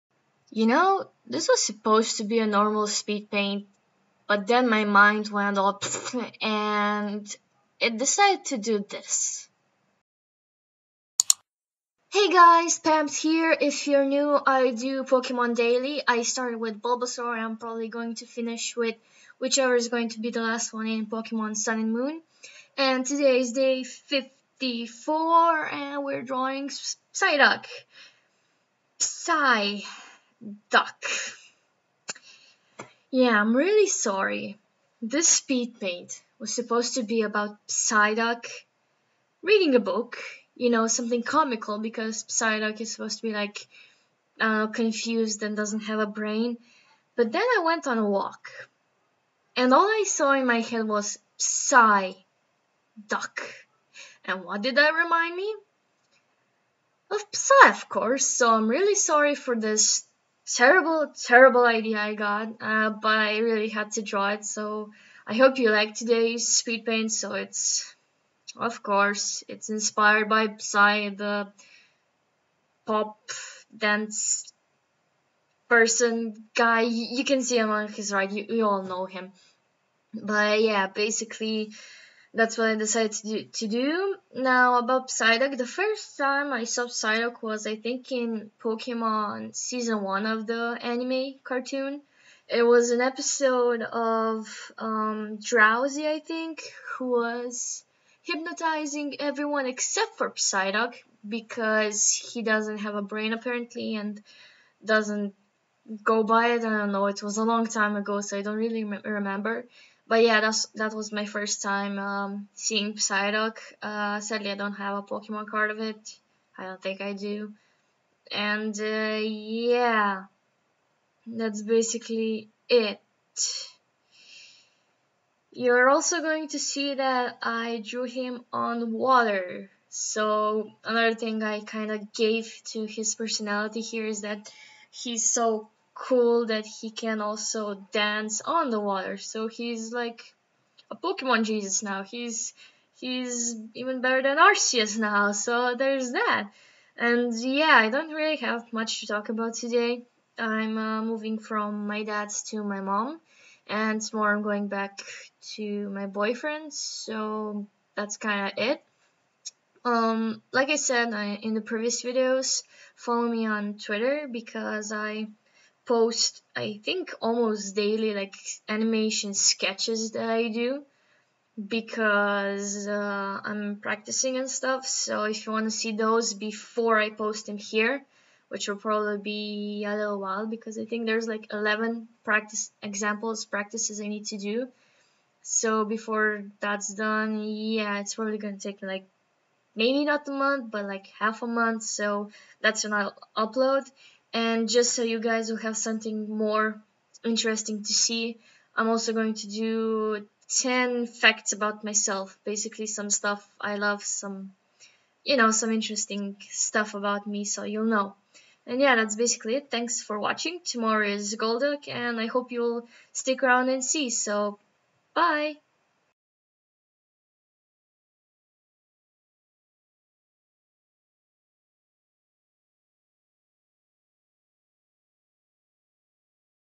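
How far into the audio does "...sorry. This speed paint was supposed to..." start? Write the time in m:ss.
0:33.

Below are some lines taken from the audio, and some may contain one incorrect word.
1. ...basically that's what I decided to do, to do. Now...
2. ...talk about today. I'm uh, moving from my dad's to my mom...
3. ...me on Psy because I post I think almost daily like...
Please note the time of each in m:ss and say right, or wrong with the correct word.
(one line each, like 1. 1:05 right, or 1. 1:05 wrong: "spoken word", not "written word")
1. 1:20 right
2. 2:29 right
3. 2:43 wrong: "Twitter", not "Psy".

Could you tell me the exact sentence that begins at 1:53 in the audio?
Uh, sadly, I don't have a Pokemon card of it.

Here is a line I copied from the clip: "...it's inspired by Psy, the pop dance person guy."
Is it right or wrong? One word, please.
right.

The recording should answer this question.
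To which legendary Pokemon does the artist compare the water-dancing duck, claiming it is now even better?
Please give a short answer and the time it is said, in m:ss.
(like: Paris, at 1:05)
Arceus, at 2:24.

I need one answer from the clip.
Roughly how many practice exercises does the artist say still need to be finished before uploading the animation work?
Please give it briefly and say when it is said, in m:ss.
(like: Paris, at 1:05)
11, at 3:01.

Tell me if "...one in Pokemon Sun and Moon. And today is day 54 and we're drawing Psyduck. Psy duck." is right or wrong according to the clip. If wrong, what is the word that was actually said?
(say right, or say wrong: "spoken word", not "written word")
right.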